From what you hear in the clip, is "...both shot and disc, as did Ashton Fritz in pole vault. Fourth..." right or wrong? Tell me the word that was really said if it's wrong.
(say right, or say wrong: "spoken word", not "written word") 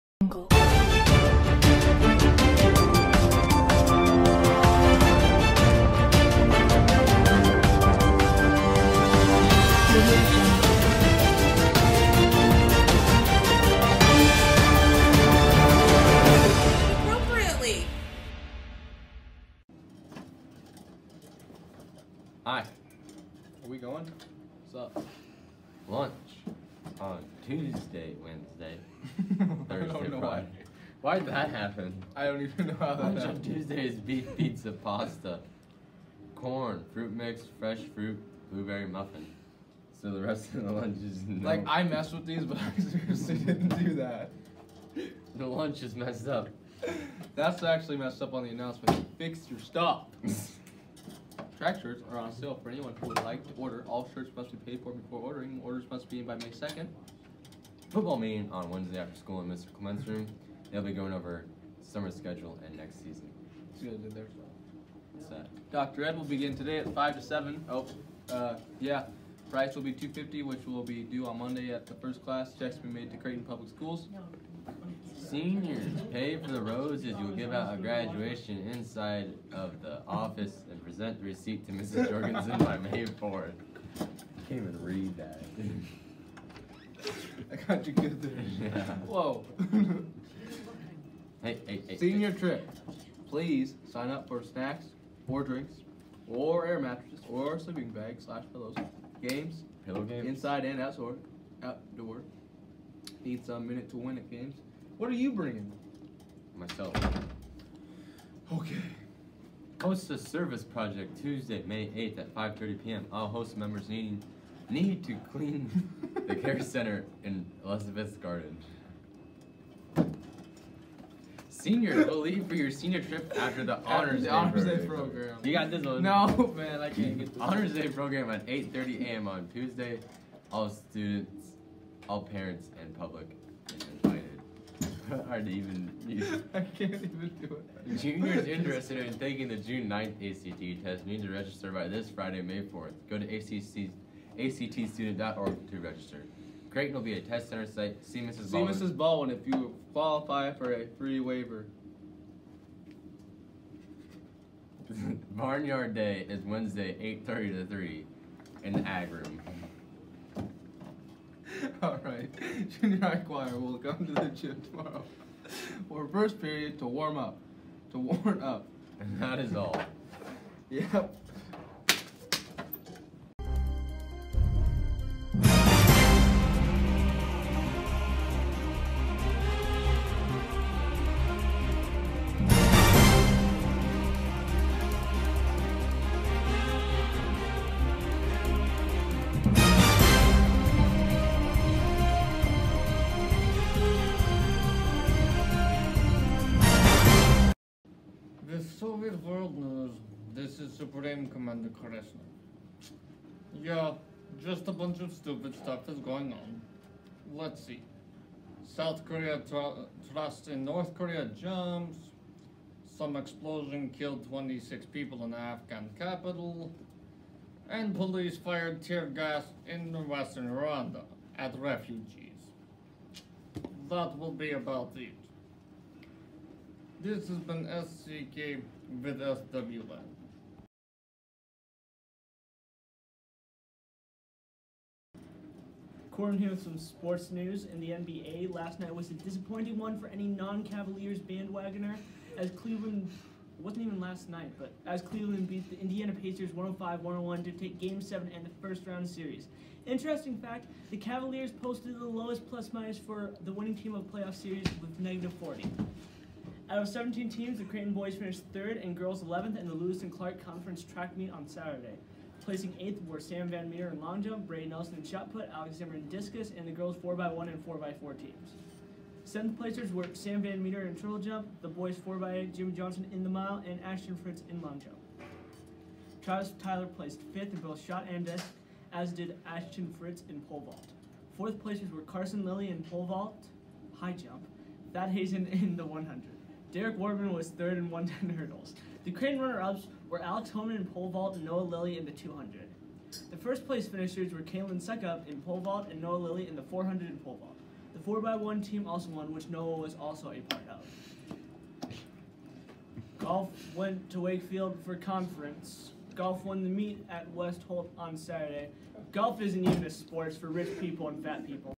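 right.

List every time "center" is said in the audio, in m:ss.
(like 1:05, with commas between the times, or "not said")
1:56, 2:27.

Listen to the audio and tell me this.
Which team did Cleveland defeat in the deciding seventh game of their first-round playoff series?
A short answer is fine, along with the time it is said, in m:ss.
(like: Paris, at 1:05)
Indiana Pacers, at 4:05.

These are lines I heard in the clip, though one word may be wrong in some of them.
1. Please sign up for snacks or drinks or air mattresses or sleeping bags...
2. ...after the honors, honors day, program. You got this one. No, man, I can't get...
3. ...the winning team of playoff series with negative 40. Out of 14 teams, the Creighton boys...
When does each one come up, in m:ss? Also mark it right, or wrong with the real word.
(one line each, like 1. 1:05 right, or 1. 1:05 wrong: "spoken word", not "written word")
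1. 1:33 right
2. 2:03 right
3. 4:13 wrong: "17", not "14".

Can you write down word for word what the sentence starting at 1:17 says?
You'll give out a graduation inside of the office and present the receipt to Mrs.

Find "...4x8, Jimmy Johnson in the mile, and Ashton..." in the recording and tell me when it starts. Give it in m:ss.
4:32.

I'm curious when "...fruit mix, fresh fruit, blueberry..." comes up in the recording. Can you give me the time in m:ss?
0:36.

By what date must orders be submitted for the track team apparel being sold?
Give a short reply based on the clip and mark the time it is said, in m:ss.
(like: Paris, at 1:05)
May 2nd, at 0:56.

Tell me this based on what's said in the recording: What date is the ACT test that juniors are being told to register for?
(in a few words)
June 9th.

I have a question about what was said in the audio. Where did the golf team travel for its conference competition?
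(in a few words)
Wakefield.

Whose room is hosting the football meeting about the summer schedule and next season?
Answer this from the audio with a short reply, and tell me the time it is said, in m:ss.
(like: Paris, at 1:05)
Mr. Clement's, at 0:59.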